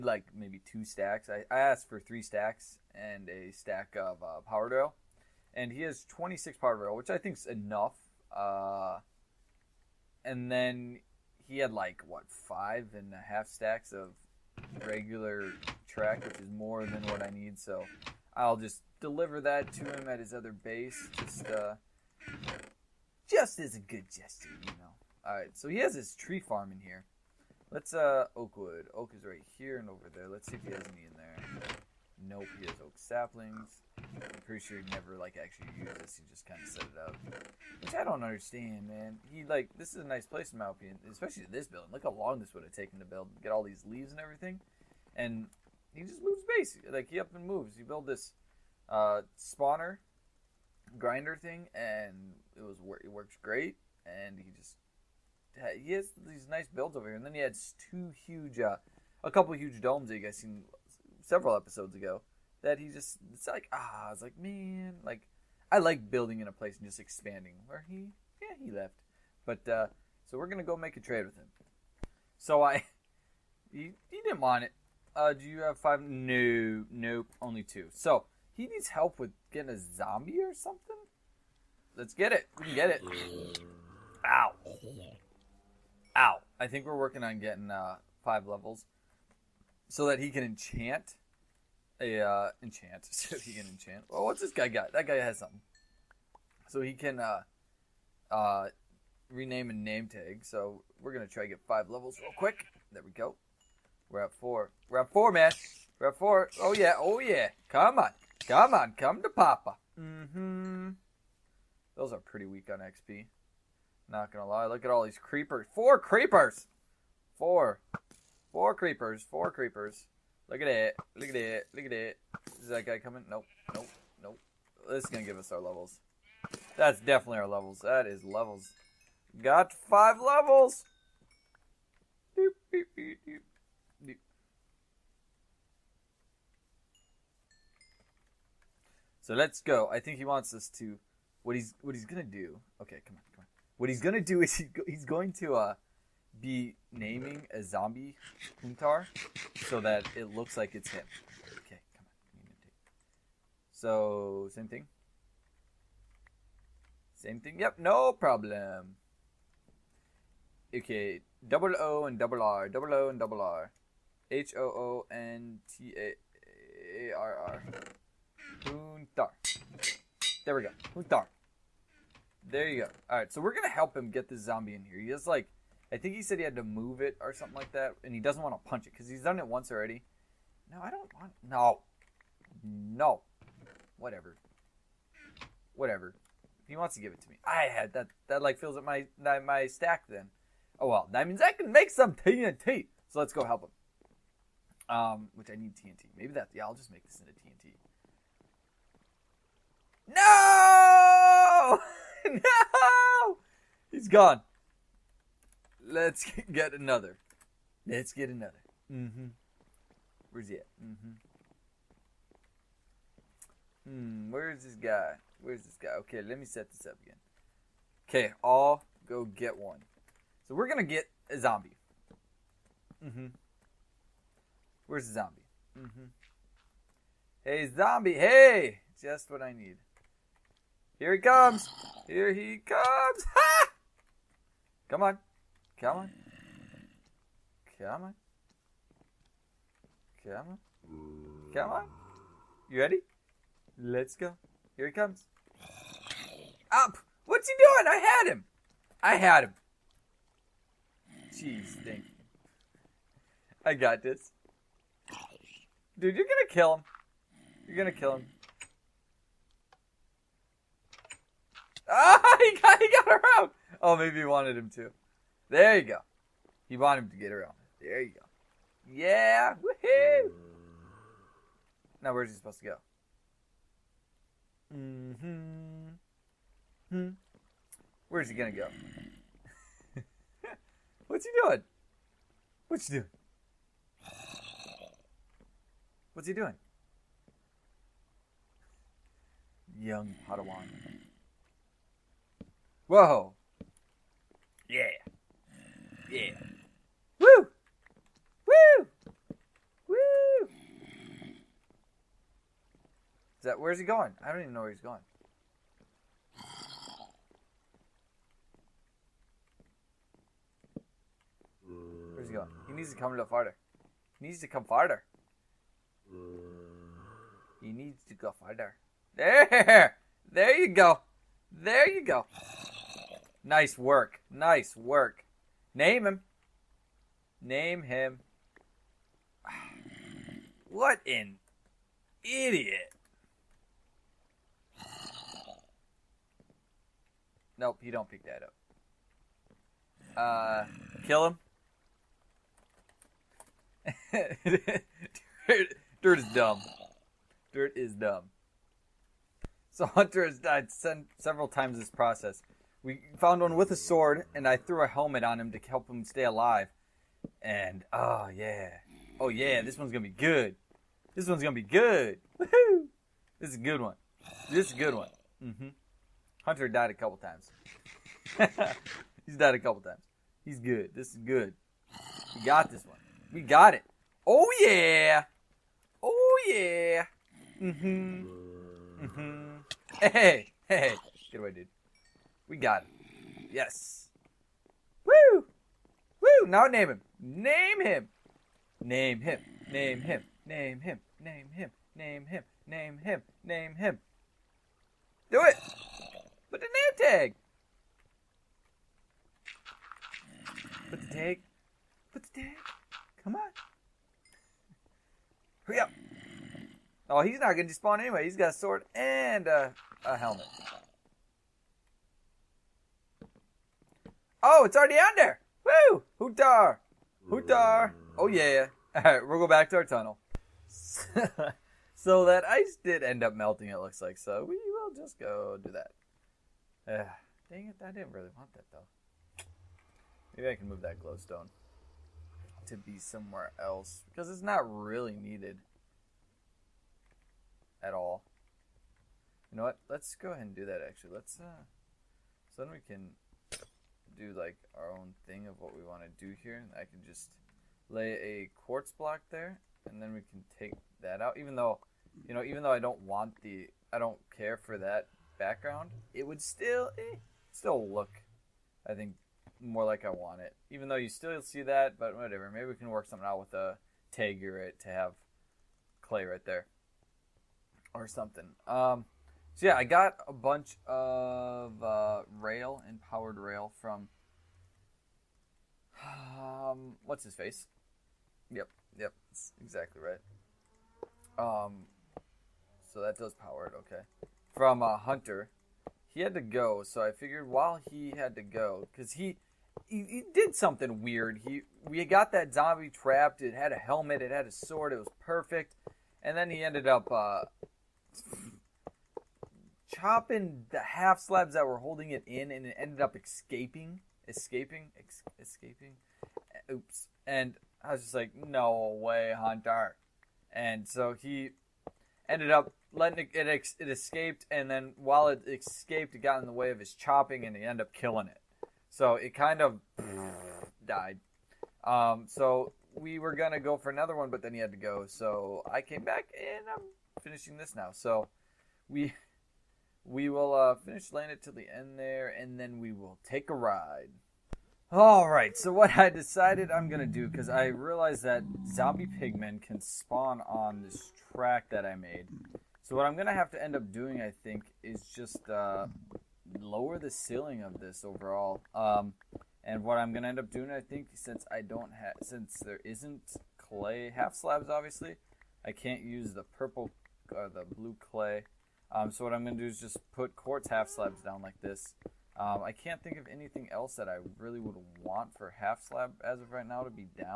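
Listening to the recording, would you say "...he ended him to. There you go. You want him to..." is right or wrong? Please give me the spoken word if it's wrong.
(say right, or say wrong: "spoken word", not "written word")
wrong: "wanted", not "ended".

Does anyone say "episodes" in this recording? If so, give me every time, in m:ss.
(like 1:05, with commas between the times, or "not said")
1:01.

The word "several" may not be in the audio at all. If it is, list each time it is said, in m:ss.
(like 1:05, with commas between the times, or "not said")
1:01, 5:51.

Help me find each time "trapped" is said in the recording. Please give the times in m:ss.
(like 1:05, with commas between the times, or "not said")
8:12.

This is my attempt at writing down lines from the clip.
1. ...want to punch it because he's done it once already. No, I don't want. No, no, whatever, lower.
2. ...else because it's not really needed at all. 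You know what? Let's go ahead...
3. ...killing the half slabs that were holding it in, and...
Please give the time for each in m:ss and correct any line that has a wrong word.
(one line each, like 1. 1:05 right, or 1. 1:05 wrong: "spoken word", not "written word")
1. 2:58 wrong: "whatever", not "lower"
2. 7:13 right
3. 8:19 wrong: "chopping", not "killing".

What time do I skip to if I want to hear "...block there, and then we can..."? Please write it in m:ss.
7:28.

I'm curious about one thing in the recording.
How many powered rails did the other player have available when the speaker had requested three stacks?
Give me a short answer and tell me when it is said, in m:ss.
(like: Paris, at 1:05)
26, at 0:06.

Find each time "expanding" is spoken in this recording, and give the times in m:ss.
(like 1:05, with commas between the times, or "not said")
1:06.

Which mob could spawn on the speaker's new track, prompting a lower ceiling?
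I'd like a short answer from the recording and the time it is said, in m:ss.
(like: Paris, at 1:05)
Zombie pigmen, at 8:58.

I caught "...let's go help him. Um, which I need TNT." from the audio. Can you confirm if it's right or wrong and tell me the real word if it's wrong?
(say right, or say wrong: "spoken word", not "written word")
right.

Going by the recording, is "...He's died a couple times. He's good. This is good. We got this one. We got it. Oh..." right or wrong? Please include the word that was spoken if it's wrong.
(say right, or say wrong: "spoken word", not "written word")
right.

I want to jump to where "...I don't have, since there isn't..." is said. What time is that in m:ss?
9:11.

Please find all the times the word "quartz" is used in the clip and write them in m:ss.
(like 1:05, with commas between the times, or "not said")
7:28, 9:20.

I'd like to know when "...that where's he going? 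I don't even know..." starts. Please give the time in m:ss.
5:03.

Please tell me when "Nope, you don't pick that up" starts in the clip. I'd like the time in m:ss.
5:37.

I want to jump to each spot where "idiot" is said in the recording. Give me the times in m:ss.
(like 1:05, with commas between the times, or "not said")
5:32.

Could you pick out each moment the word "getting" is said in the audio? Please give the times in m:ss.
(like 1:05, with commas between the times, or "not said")
1:19, 1:27.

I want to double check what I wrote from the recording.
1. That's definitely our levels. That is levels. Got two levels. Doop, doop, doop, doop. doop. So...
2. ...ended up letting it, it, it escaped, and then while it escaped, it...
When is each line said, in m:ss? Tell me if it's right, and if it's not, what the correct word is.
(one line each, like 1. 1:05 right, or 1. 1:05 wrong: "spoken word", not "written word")
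1. 2:06 wrong: "five", not "two"
2. 8:32 right.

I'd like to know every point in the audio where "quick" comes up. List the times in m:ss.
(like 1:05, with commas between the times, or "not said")
1:42.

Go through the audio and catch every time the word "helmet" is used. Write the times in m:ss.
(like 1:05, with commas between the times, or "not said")
5:54, 6:50, 8:13.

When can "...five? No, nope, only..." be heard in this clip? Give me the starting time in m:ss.
1:15.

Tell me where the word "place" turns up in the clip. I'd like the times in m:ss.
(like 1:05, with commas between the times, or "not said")
0:40, 1:06.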